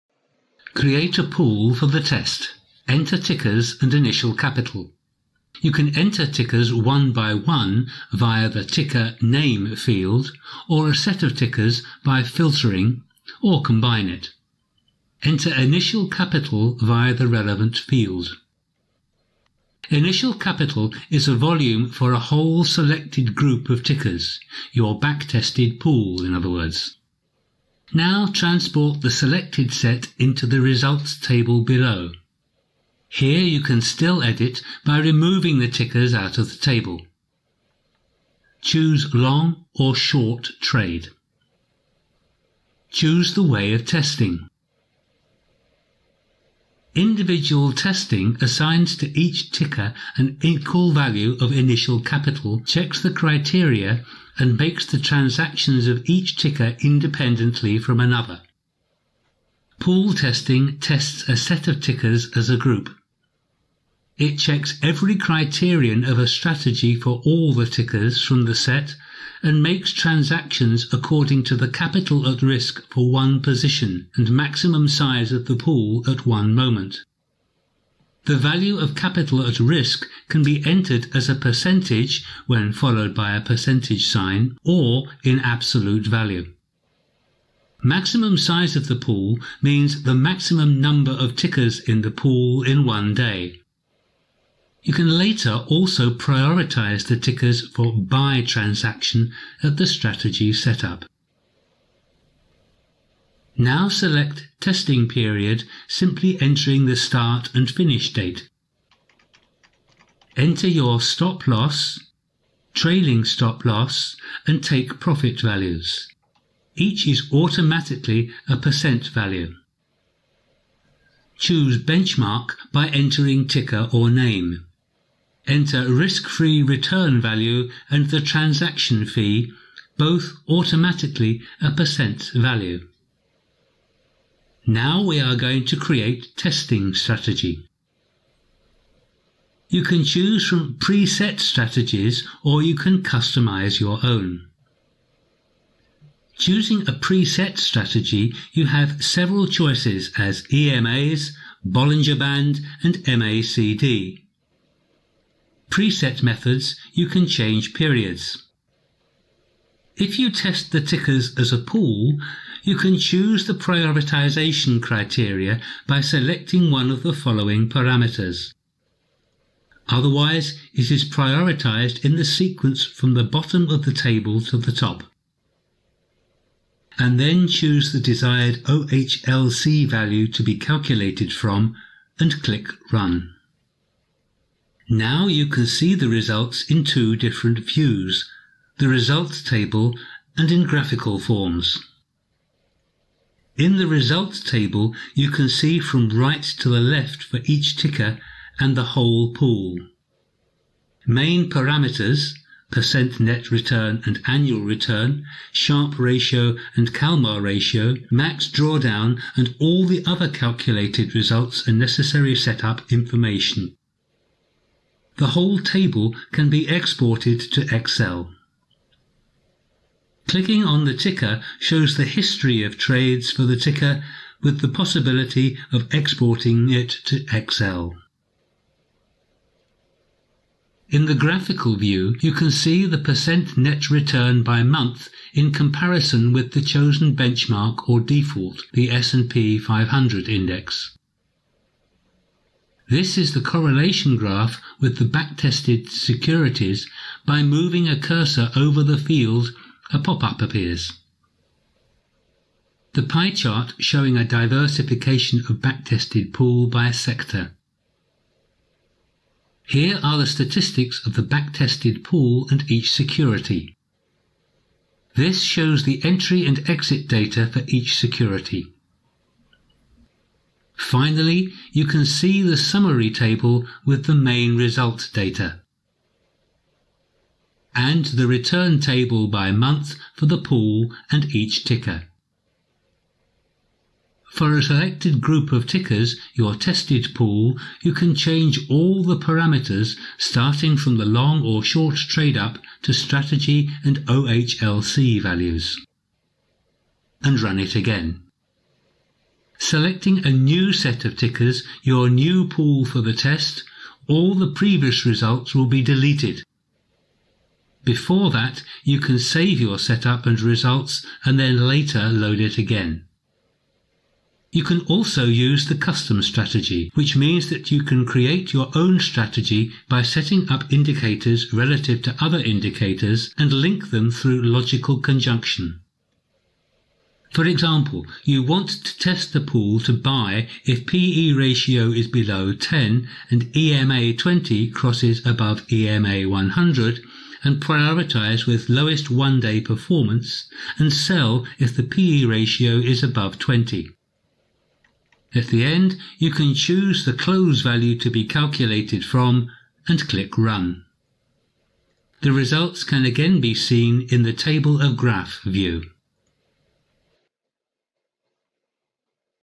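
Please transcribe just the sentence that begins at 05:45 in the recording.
At the end, you can choose the close value to be calculated from and click Run.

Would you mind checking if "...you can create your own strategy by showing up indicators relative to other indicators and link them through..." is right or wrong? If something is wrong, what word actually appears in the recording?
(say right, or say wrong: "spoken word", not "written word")
wrong: "setting", not "showing".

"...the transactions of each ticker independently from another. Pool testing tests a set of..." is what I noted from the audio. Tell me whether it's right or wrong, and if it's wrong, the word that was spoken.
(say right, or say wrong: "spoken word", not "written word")
right.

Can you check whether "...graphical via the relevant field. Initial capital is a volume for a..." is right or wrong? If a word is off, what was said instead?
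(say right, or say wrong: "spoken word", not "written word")
wrong: "capital", not "graphical".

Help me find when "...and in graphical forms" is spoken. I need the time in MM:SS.
03:10.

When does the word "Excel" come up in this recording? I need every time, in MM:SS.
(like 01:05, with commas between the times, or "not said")
03:37, 03:47.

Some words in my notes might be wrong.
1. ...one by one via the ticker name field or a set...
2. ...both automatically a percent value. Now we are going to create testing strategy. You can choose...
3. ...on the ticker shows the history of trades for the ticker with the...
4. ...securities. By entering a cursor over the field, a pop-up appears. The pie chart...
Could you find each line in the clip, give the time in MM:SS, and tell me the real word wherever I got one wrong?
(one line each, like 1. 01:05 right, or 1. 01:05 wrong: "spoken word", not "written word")
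1. 00:06 right
2. 02:09 right
3. 03:40 right
4. 04:05 wrong: "moving", not "entering".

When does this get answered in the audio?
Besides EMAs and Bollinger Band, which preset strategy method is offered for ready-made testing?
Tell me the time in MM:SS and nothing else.
02:33.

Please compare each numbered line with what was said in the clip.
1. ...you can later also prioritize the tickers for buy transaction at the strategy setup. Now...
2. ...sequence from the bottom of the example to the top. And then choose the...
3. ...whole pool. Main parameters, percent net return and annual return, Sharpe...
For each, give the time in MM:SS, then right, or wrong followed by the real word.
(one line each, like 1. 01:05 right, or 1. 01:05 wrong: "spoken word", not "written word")
1. 01:34 right
2. 02:52 wrong: "table", not "example"
3. 03:18 right.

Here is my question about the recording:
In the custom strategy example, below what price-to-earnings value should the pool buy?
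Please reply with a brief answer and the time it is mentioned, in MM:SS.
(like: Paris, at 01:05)
10, at 05:32.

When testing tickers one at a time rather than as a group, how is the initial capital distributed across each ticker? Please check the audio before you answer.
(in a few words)
Equal value.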